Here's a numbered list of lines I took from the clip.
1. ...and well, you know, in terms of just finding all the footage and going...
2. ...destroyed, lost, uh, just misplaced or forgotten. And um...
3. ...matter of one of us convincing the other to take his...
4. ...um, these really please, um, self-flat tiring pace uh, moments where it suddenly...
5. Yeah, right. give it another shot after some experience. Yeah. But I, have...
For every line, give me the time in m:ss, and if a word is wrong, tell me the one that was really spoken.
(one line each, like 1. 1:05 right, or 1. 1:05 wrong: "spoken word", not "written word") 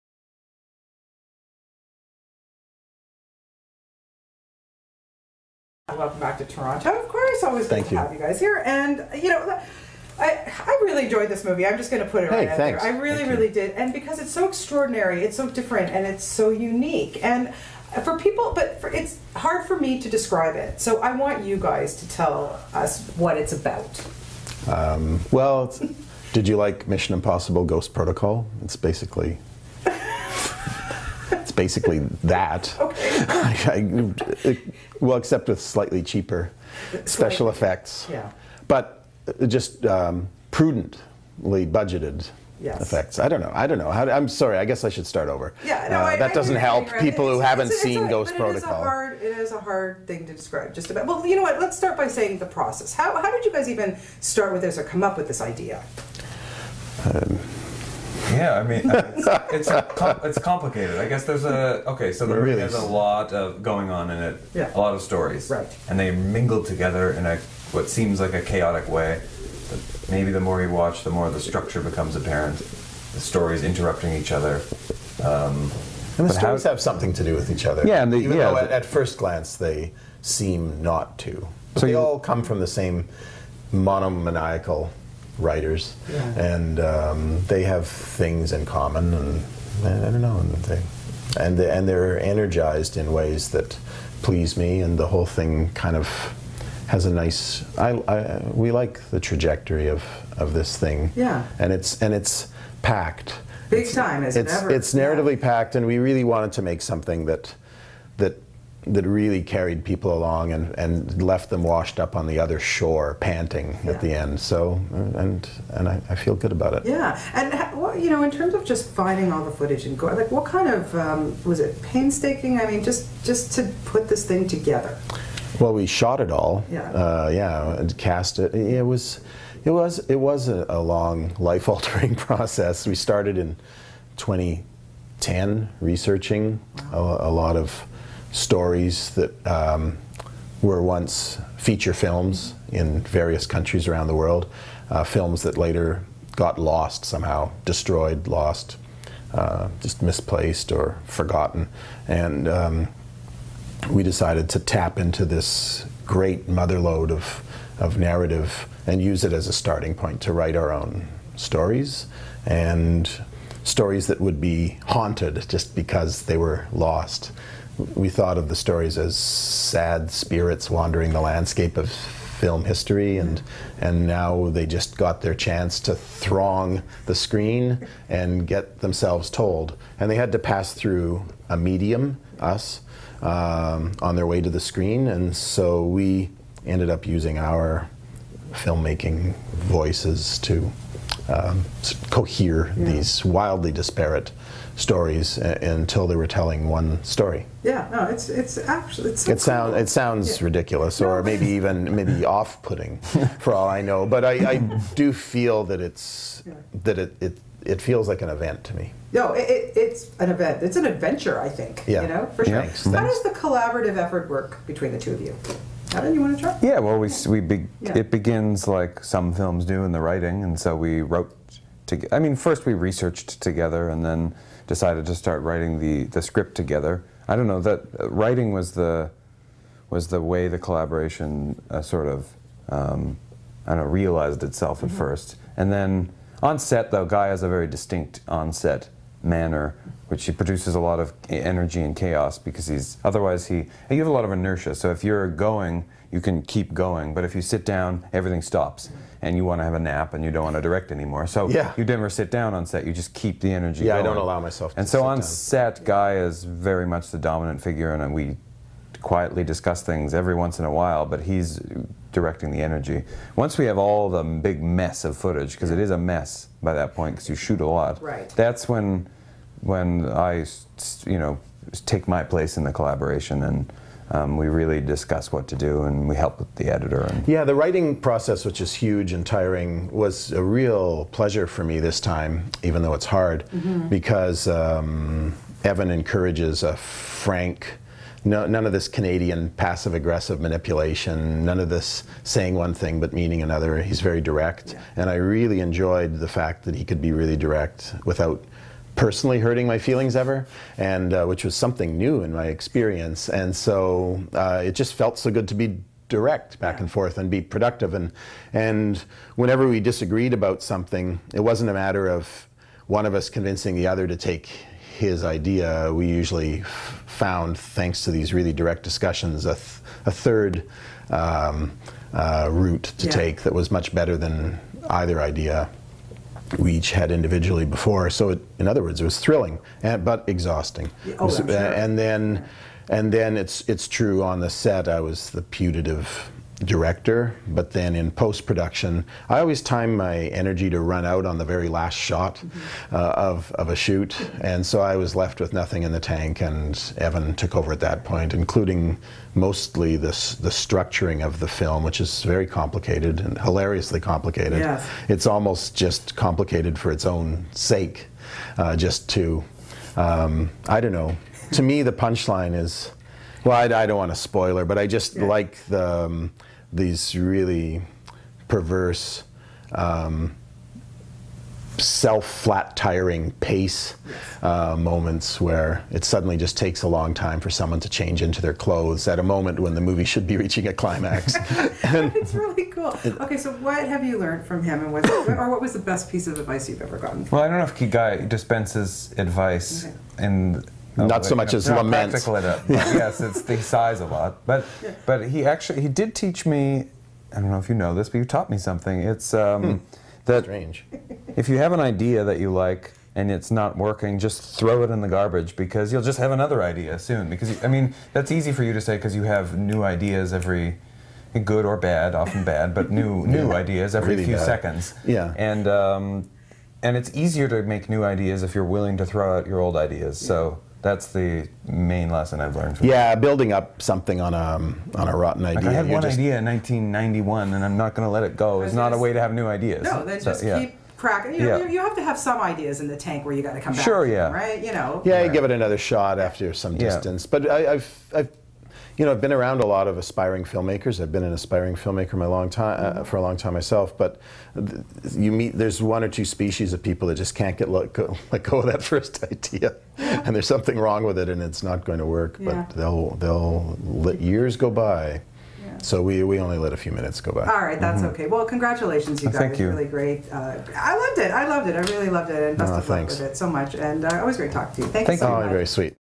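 1. 1:57 right
2. 2:27 right
3. 5:11 right
4. 6:06 wrong: "perverse", not "please"
5. 7:15 wrong: "distance", not "experience".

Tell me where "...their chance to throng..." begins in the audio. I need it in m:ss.
2:55.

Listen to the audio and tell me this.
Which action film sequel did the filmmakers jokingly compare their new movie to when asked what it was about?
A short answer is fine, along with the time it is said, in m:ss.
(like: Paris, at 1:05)
Mission Impossible Ghost Protocol, at 0:26.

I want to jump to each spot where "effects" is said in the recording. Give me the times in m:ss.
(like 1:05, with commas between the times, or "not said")
0:37, 0:42.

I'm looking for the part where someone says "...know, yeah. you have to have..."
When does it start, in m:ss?
7:11.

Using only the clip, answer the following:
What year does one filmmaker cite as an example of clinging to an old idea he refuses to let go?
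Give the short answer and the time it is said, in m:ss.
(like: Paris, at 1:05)
1991, at 7:06.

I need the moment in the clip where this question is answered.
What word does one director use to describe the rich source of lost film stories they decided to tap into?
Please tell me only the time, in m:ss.
2:36.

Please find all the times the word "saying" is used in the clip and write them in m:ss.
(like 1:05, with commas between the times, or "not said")
0:52, 4:52.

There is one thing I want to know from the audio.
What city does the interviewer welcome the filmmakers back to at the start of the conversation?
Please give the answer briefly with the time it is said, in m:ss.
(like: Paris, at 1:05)
Toronto, at 0:06.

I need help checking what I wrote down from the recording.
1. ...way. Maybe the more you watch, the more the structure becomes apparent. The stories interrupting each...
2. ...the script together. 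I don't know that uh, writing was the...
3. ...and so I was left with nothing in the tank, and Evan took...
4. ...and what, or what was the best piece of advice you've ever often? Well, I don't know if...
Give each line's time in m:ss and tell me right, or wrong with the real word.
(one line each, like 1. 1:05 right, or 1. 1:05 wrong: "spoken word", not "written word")
1. 1:08 right
2. 3:46 right
3. 5:44 right
4. 6:24 wrong: "gotten", not "often".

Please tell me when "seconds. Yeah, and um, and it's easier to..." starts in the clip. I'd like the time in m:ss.
6:54.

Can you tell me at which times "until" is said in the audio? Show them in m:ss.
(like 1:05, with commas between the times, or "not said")
3:15.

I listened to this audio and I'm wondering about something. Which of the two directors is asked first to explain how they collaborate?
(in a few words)
Adam.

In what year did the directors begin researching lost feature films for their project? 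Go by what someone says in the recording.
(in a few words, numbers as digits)
2010.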